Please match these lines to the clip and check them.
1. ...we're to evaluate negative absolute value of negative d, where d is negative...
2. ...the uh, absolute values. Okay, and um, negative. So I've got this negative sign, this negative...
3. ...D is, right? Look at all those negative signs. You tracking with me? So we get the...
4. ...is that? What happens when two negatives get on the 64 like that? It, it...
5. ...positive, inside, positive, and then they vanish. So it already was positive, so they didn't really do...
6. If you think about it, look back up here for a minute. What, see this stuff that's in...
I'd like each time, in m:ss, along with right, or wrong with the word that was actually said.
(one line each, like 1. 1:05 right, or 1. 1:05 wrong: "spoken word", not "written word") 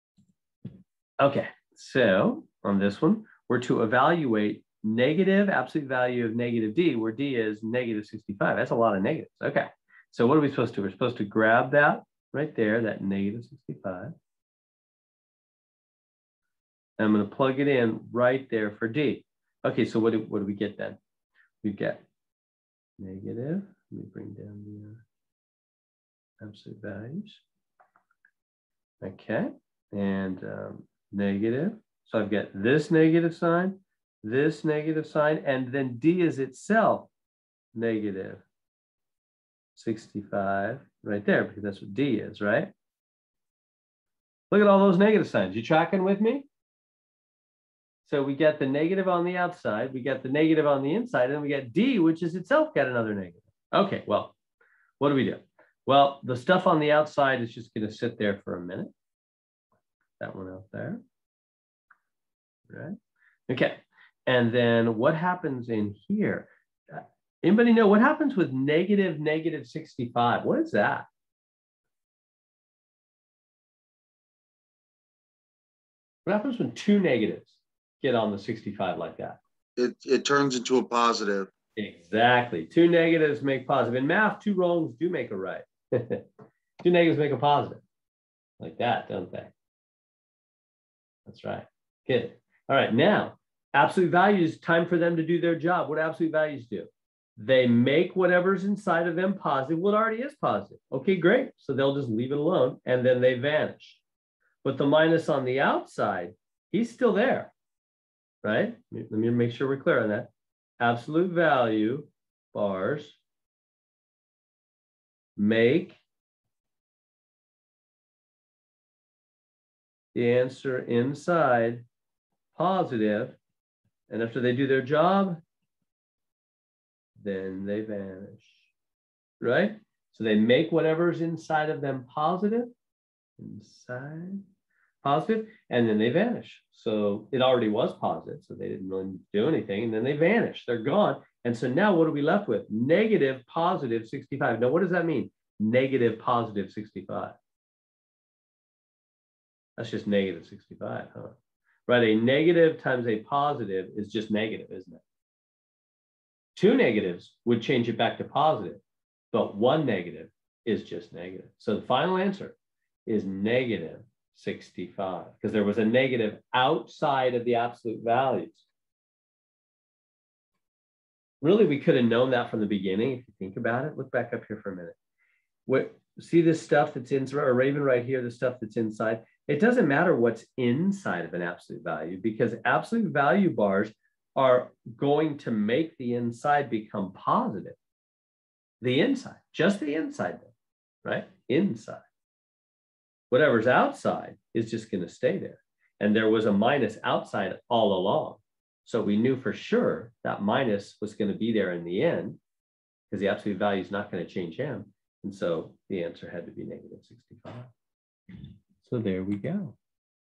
1. 0:03 right
2. 0:24 right
3. 0:41 right
4. 1:10 wrong: "65", not "64"
5. 2:12 right
6. 2:53 right.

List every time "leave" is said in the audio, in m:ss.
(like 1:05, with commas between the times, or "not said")
1:42.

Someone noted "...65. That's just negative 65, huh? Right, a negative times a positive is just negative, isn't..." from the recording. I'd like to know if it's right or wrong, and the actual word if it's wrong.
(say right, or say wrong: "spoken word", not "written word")
right.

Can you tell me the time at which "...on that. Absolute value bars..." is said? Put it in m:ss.
1:50.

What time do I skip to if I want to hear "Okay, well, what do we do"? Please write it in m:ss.
0:53.